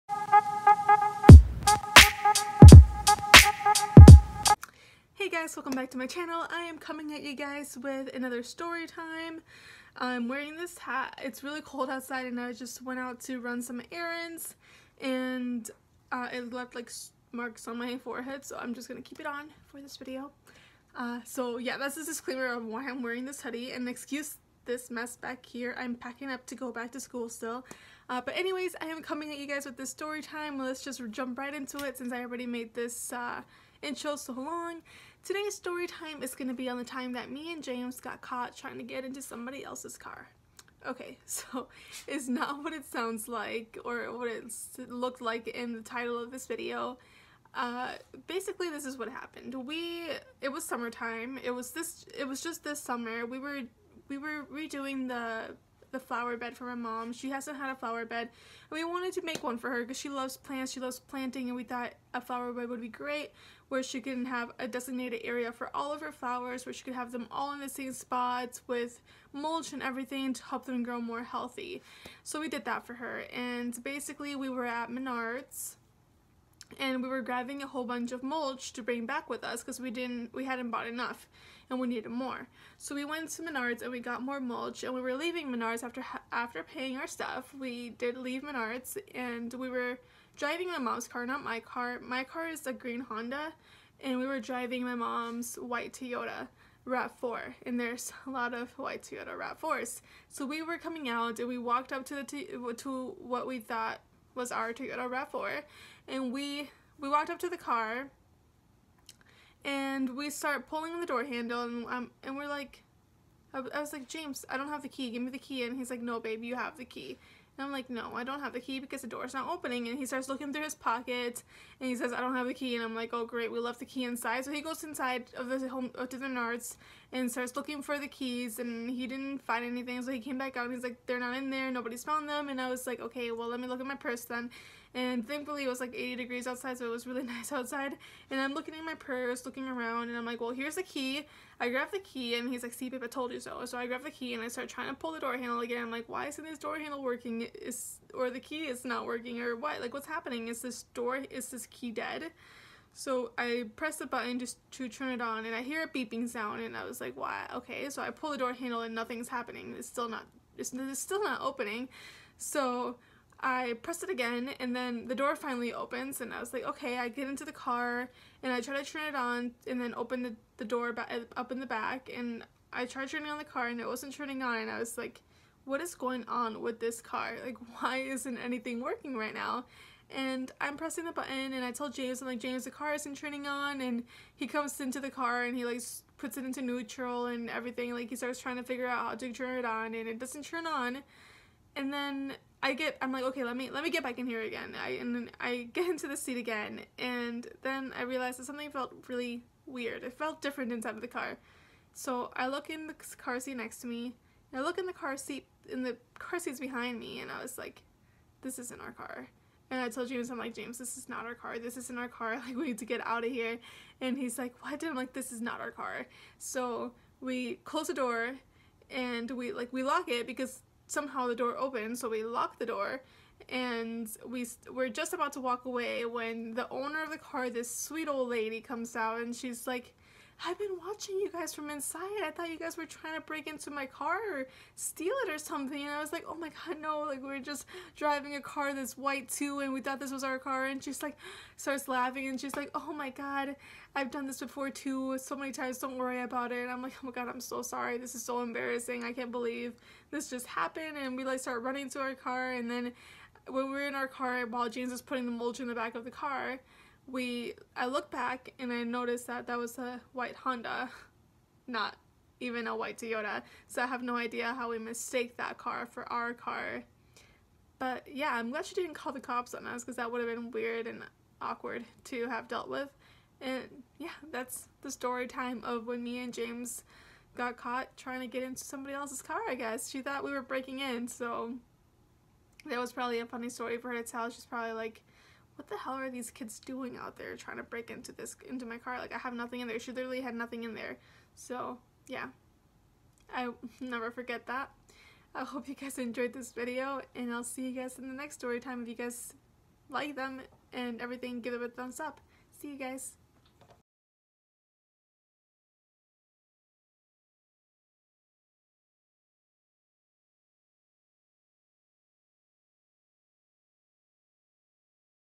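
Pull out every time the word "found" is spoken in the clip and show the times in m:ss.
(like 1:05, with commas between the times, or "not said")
2:12.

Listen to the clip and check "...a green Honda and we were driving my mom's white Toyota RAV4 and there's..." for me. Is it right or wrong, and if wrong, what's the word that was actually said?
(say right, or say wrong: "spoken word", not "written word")
right.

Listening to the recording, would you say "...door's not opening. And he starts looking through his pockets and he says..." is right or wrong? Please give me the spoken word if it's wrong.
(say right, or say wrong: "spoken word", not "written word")
right.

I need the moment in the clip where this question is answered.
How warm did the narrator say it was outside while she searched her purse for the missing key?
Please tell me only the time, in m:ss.
2:15.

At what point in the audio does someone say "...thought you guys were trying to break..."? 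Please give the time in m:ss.
3:52.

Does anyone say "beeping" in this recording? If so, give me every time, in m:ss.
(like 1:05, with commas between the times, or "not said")
2:35.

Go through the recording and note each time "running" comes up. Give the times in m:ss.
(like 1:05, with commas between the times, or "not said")
4:11.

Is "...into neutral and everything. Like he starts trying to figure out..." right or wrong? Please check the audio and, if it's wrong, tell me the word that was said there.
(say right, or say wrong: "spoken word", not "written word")
right.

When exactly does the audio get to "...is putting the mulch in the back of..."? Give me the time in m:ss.
4:14.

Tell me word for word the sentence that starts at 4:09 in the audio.
I can't believe this just happened.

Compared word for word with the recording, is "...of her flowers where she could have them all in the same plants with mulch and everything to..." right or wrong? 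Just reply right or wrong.
wrong.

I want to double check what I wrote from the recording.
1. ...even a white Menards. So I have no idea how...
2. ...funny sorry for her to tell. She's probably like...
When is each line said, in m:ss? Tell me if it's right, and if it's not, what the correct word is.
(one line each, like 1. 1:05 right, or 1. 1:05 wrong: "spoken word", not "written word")
1. 4:22 wrong: "Toyota", not "Menards"
2. 4:43 wrong: "story", not "sorry".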